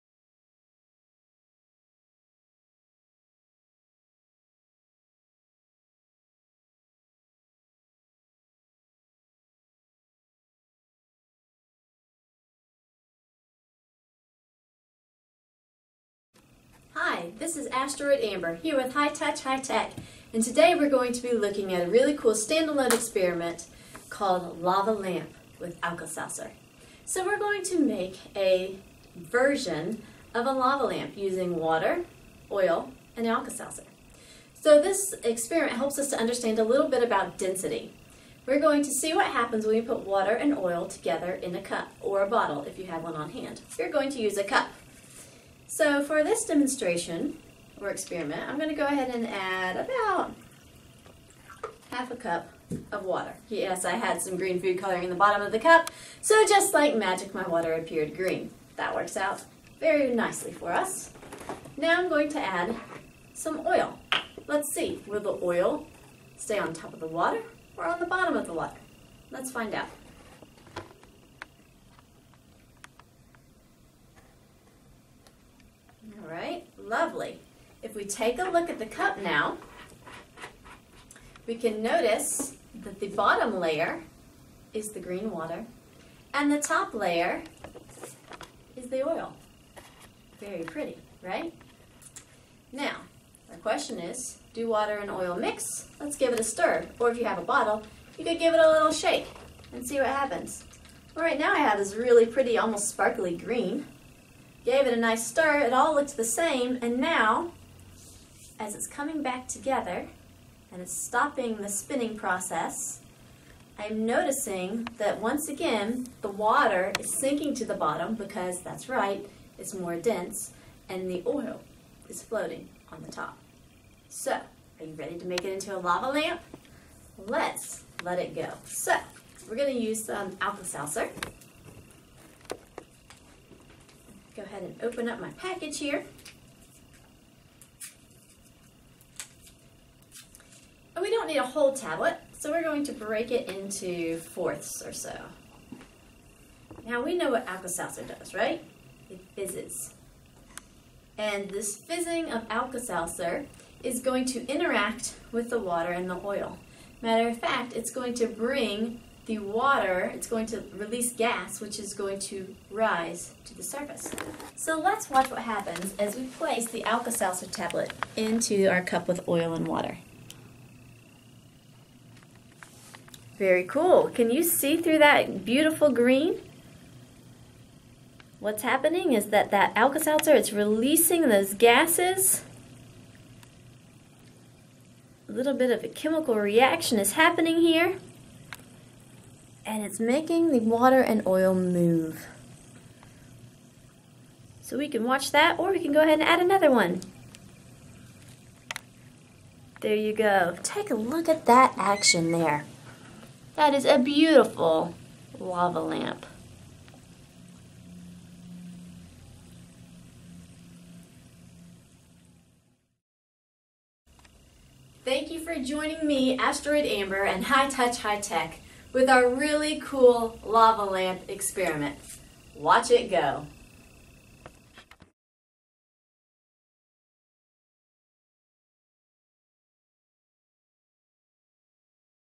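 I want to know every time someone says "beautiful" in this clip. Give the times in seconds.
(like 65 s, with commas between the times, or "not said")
175 s, 203 s.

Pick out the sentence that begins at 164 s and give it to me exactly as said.
So let's watch what happens as we place the Alka-Seltzer tablet into our cup with oil and water.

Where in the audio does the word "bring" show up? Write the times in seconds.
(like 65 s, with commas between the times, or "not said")
158 s.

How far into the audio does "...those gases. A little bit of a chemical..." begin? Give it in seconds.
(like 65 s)
181 s.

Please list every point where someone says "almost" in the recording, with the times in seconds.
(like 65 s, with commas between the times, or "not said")
102 s.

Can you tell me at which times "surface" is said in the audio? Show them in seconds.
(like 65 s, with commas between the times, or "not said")
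163 s.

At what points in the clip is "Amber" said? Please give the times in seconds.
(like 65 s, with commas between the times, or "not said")
18 s, 216 s.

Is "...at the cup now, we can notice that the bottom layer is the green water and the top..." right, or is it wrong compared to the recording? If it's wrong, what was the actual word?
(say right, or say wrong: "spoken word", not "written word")
right.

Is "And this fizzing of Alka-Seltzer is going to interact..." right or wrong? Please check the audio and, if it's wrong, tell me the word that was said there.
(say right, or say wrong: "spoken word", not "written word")
right.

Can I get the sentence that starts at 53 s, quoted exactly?
Yes, I had some green food coloring in the bottom of the cup, so just like magic, my water appeared green.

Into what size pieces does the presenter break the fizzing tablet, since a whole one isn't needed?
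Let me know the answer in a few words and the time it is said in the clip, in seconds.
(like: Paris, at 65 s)
fourths, at 144 s.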